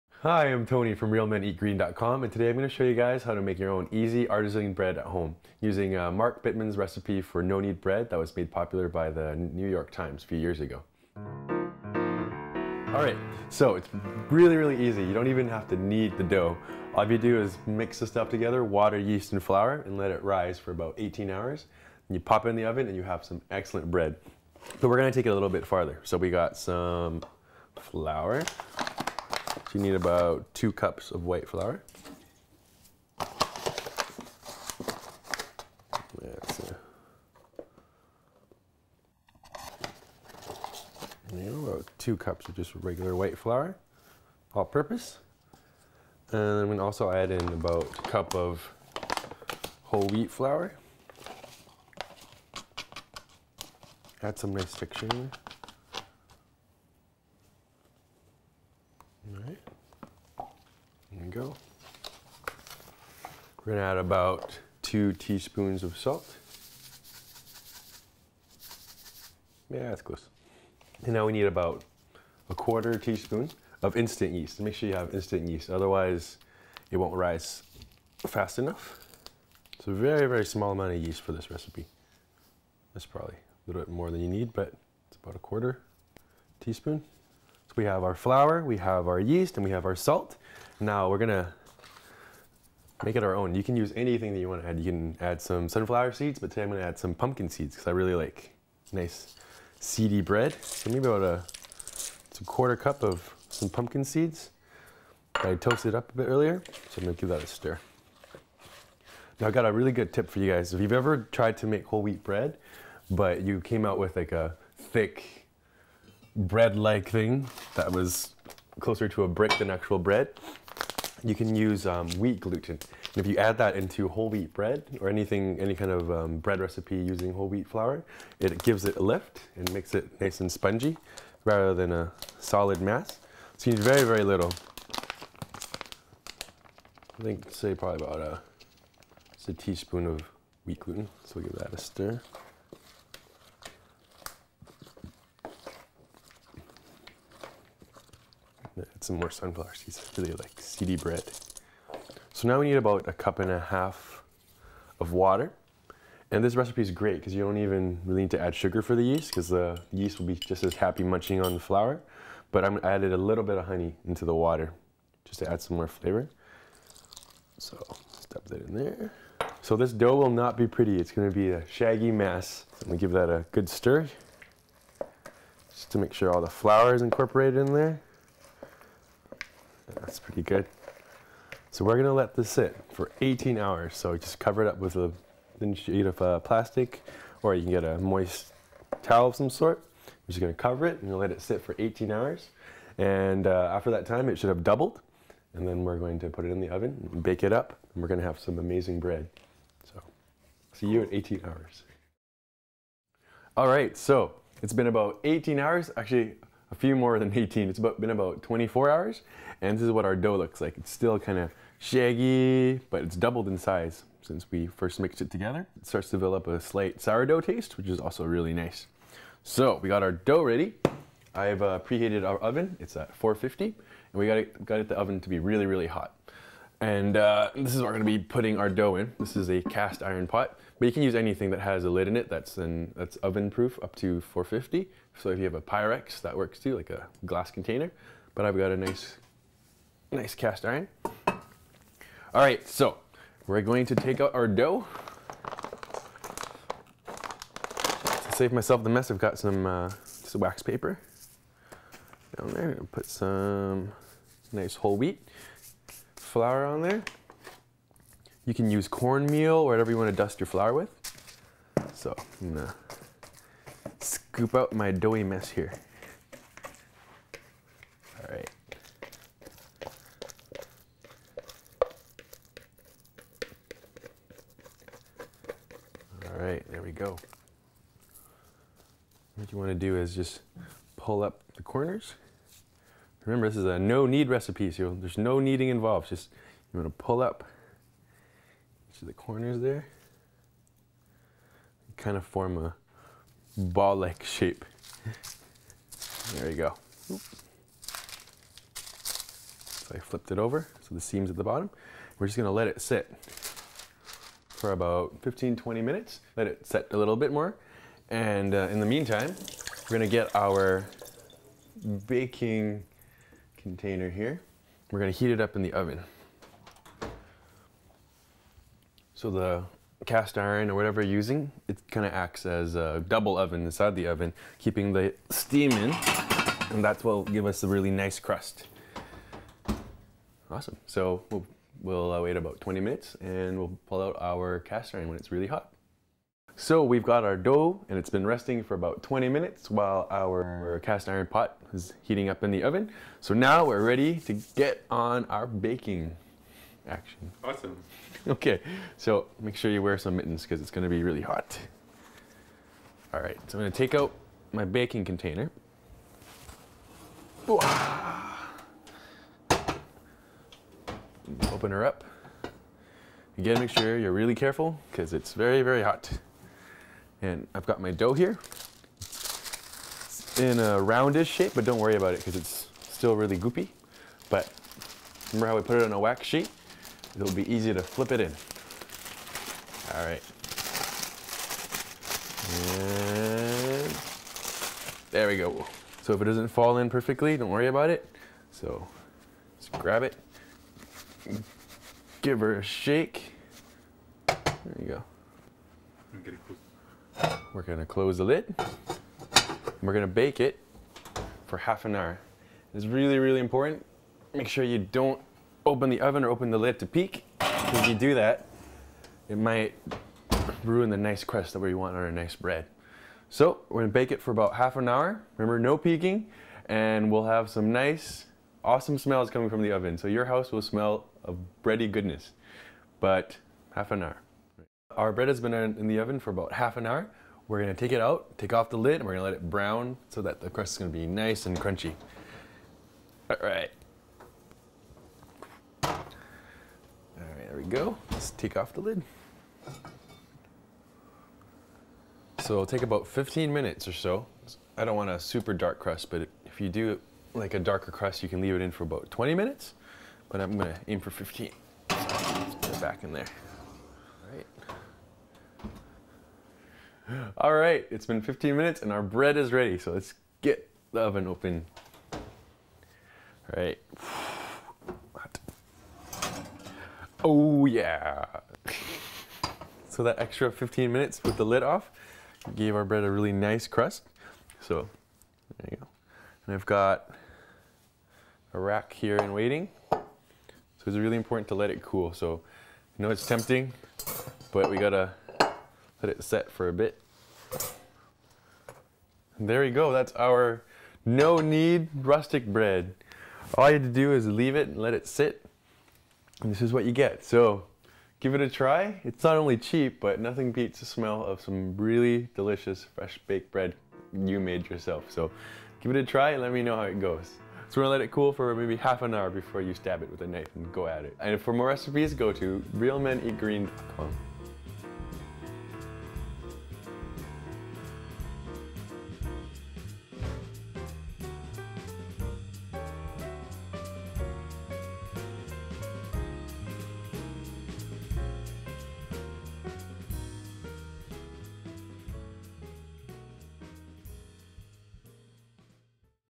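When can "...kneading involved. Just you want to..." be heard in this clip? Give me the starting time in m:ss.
4:45.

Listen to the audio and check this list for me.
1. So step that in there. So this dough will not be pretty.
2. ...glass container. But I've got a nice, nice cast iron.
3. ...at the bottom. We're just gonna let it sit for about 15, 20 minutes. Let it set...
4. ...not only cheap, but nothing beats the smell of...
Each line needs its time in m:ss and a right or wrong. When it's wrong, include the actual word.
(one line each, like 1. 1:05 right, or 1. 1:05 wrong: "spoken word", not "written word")
1. 2:47 right
2. 3:57 right
3. 5:01 right
4. 8:19 right.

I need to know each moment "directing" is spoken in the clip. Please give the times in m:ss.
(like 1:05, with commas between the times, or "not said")
not said.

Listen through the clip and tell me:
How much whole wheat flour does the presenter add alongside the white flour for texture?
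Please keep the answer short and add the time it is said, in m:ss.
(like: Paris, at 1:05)
1 cup, at 0:47.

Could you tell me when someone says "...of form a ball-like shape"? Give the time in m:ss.
4:52.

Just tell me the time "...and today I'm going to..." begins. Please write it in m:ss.
0:02.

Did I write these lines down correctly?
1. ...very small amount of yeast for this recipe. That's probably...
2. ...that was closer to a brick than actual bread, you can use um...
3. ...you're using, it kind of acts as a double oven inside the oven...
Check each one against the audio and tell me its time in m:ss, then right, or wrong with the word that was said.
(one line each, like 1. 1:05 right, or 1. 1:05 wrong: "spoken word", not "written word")
1. 1:20 right
2. 1:57 right
3. 5:21 right.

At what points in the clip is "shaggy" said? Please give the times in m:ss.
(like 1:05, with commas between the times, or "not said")
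2:51, 3:31.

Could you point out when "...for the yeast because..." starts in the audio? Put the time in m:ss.
2:38.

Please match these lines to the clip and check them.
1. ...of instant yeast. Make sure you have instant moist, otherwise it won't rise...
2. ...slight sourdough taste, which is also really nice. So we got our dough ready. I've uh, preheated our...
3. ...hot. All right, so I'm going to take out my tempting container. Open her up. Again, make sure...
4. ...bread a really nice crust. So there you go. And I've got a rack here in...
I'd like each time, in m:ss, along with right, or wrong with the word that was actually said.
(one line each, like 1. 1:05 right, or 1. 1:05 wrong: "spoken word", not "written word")
1. 1:13 wrong: "yeast", not "moist"
2. 3:36 right
3. 5:51 wrong: "baking", not "tempting"
4. 7:52 right.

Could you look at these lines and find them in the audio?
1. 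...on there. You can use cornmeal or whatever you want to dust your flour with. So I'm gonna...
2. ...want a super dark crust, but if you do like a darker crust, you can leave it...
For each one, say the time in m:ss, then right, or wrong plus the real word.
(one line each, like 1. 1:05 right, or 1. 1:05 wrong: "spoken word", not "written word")
1. 4:16 right
2. 7:24 right.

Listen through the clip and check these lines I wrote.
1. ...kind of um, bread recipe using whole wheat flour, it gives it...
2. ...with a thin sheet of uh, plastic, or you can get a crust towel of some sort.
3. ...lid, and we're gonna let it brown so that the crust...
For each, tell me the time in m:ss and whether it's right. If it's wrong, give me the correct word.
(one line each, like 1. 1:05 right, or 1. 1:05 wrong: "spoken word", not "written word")
1. 2:05 right
2. 3:04 wrong: "moist", not "crust"
3. 7:08 right.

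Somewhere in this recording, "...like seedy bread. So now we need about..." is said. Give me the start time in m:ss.
2:30.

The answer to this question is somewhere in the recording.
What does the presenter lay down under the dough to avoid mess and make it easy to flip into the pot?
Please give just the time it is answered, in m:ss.
4:10.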